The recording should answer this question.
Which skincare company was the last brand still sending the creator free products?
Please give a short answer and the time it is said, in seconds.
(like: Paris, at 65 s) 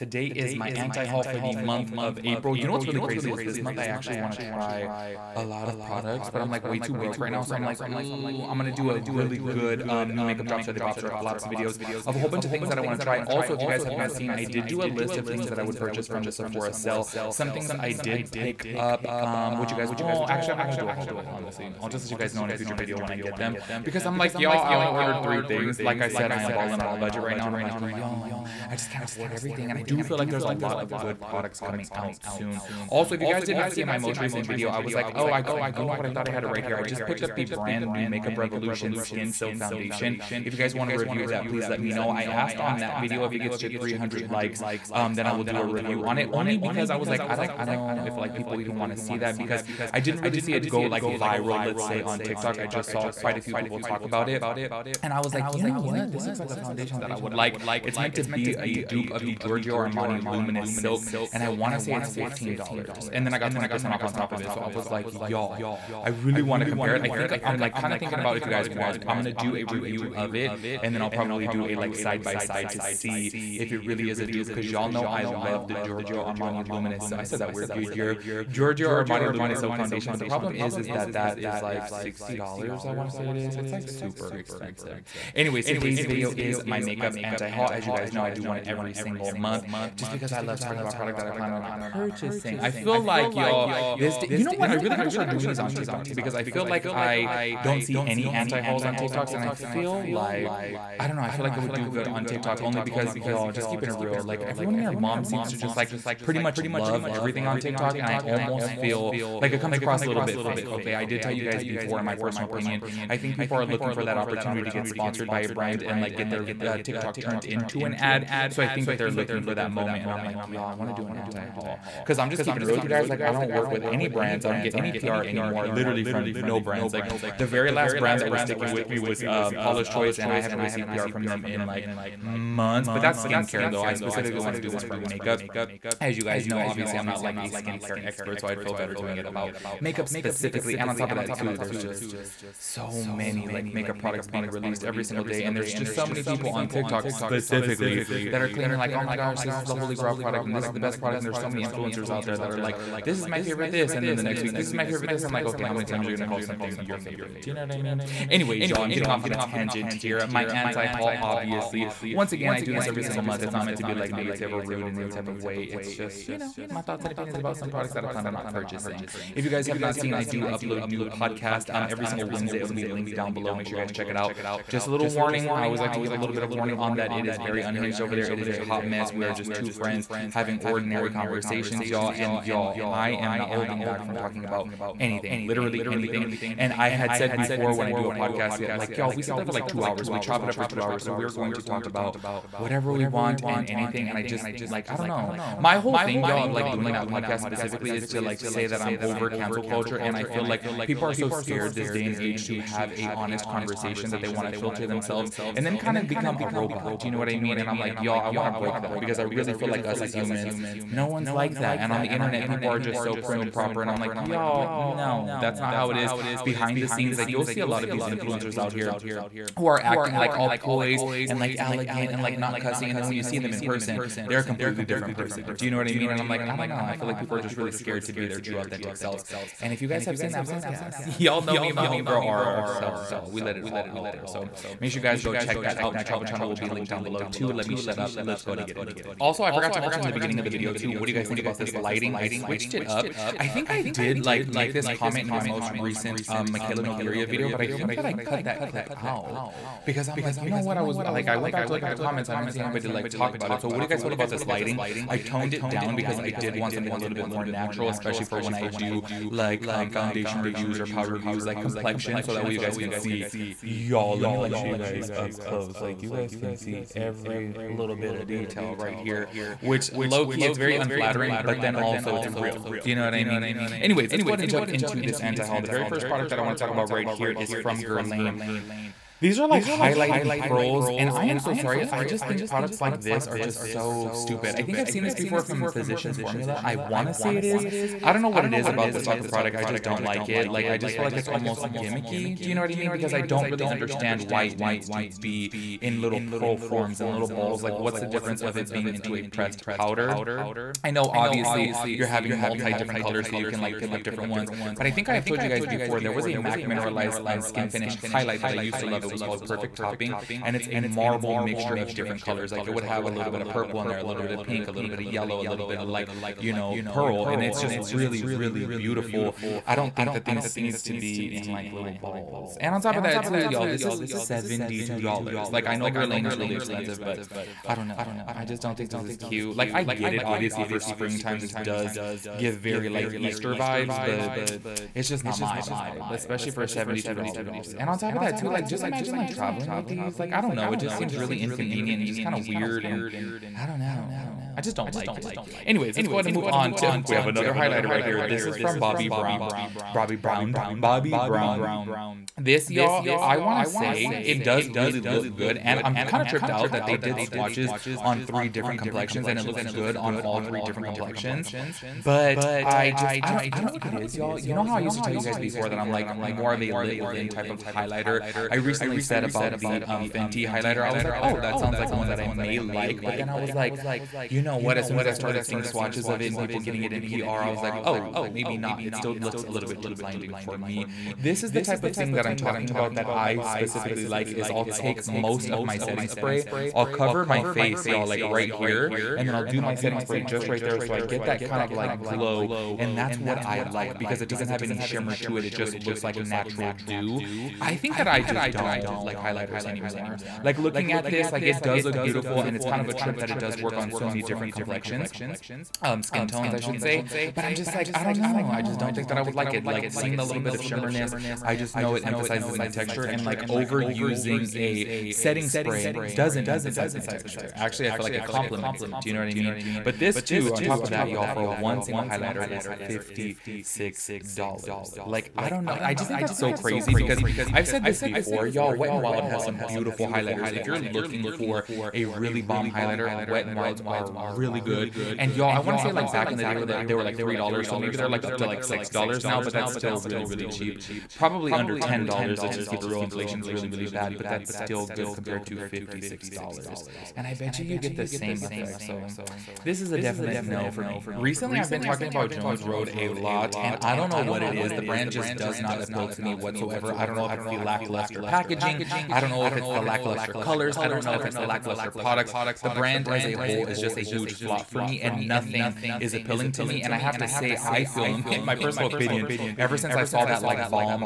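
Paula's Choice, at 129 s.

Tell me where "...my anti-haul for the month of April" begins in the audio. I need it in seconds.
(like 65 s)
0 s.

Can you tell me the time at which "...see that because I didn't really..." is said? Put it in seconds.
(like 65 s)
48 s.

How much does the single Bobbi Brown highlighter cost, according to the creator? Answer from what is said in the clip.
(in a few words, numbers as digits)
$56.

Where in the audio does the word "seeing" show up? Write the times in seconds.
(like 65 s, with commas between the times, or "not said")
375 s, 409 s.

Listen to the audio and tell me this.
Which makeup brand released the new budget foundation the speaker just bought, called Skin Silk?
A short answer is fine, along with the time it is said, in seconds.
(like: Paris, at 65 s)
Makeup Revolution, at 38 s.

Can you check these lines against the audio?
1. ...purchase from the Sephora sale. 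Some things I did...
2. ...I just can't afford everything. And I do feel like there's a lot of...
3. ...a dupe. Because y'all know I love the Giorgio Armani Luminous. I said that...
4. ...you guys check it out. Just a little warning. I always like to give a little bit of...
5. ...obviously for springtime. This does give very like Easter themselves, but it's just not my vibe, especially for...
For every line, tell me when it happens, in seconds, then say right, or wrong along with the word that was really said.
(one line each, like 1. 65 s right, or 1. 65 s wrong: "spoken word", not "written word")
1. 15 s right
2. 28 s right
3. 74 s right
4. 173 s right
5. 330 s wrong: "vibes", not "themselves".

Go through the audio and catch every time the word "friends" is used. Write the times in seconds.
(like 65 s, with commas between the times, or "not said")
179 s.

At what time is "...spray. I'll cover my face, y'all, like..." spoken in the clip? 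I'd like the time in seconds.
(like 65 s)
386 s.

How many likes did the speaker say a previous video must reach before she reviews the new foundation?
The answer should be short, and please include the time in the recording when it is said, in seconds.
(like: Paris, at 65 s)
300, at 43 s.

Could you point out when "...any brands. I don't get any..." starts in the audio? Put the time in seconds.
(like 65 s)
123 s.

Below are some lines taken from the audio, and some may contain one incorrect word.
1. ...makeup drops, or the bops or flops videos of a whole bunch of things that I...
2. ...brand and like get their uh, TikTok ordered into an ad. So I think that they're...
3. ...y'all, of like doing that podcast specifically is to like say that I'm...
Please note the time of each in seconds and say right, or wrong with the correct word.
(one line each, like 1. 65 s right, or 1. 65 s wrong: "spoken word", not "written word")
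1. 10 s right
2. 115 s wrong: "turned", not "ordered"
3. 196 s right.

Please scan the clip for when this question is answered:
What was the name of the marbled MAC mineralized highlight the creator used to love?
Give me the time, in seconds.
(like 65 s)
309 s.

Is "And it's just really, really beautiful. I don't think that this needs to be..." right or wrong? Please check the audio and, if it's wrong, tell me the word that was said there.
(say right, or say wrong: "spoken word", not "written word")
right.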